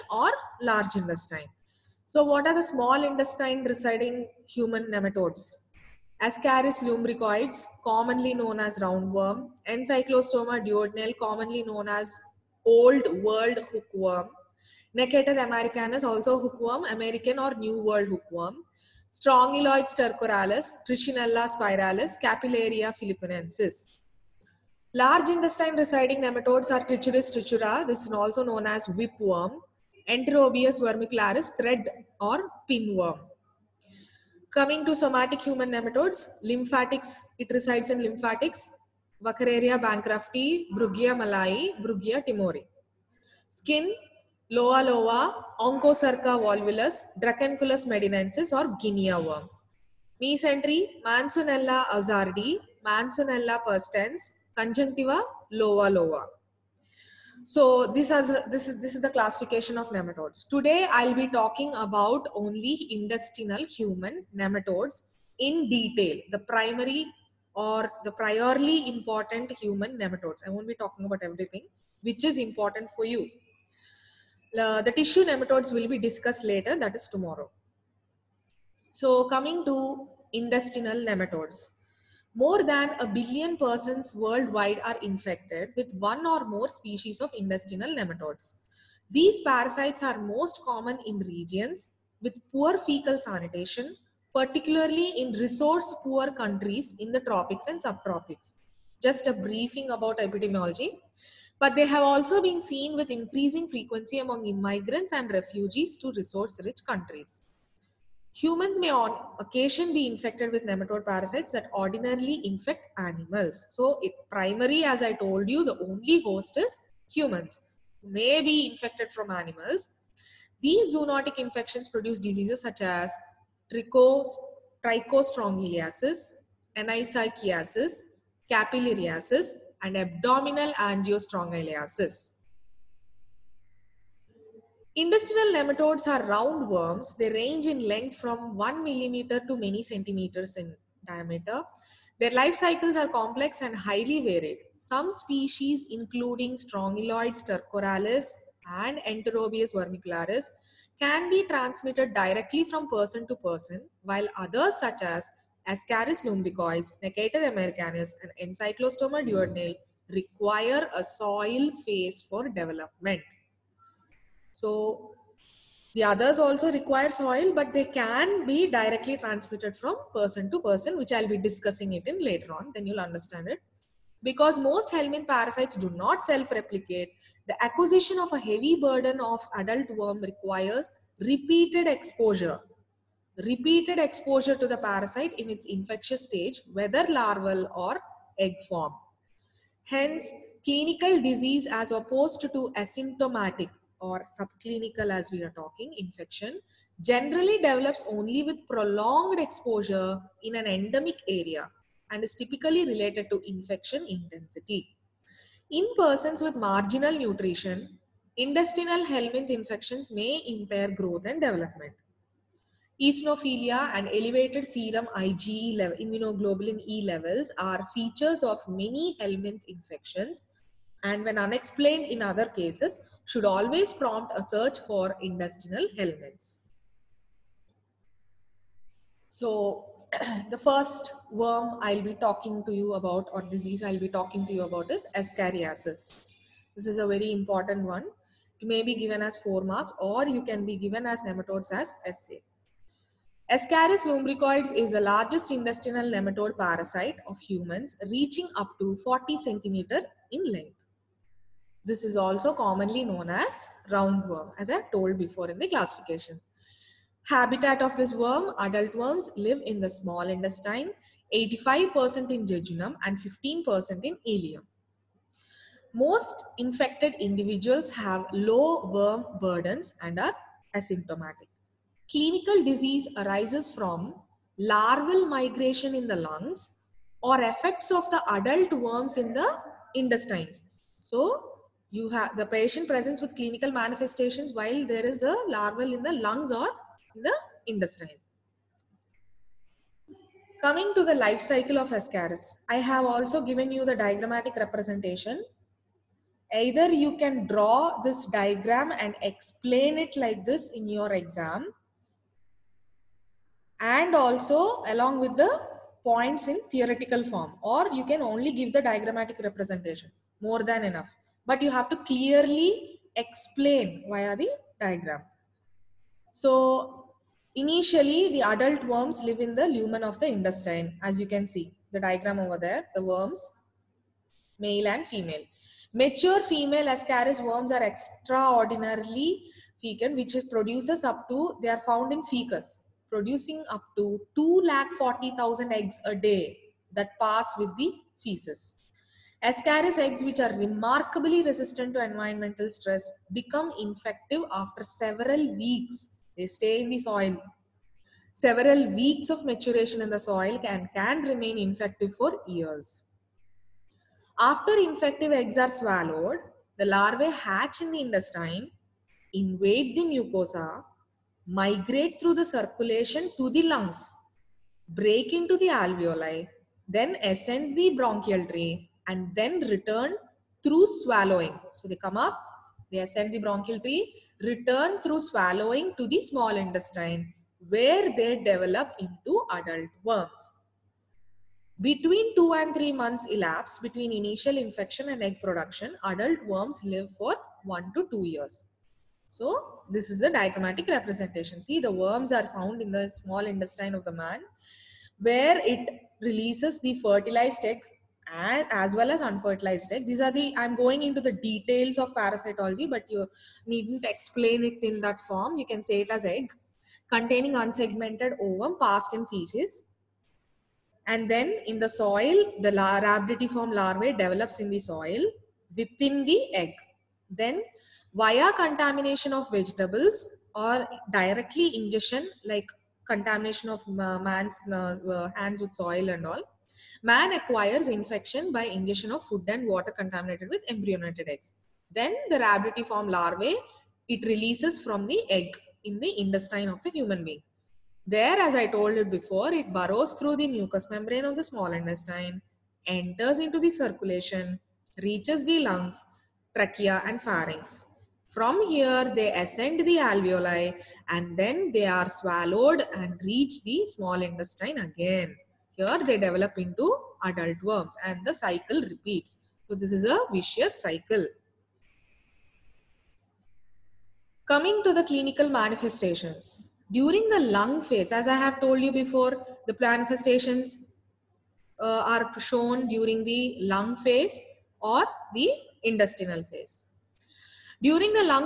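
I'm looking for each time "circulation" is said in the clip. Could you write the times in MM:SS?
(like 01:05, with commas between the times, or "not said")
06:02, 07:23.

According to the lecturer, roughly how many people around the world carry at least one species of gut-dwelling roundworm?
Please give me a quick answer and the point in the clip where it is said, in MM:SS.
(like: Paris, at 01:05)
More than a billion, at 01:22.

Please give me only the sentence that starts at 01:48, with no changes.
Humans may on occasion be infected with nematode parasites that ordinarily infect animals.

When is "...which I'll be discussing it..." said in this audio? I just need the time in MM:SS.
02:50.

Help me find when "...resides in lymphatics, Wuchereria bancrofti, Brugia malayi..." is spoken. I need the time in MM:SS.
00:37.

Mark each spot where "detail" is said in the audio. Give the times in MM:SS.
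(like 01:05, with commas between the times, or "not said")
01:05, 06:41.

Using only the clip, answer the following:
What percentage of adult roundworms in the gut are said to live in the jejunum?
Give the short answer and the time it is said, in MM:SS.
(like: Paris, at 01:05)
85%, at 04:21.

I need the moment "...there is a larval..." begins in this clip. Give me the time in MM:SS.
04:44.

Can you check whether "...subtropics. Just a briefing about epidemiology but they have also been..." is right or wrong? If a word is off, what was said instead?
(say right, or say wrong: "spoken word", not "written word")
right.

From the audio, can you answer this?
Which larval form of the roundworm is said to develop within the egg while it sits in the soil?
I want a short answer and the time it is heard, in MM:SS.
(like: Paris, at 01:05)
Rhabditiform larvae, at 06:52.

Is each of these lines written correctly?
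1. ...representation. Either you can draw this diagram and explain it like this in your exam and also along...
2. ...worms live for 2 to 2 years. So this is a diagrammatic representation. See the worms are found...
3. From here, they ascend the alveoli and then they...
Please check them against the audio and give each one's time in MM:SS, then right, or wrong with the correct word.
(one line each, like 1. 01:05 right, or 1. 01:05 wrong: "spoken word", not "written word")
1. 04:54 right
2. 06:26 wrong: "1", not "2"
3. 07:28 right.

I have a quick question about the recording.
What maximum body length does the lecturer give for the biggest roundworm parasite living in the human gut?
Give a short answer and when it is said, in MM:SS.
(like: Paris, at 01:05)
40 centimeters, at 04:09.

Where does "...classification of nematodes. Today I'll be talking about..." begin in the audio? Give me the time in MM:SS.
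00:59.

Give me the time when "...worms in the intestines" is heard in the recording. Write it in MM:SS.
04:38.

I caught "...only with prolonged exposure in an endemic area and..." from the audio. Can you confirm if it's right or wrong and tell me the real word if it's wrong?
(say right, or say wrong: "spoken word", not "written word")
right.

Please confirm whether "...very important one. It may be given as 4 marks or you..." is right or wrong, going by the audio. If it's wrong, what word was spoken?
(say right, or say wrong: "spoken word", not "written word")
right.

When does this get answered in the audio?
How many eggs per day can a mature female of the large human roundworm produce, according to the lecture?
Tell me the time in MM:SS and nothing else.
05:34.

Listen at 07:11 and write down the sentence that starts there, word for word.
Then the form larvae, it releases from the egg in the intestine of the human being.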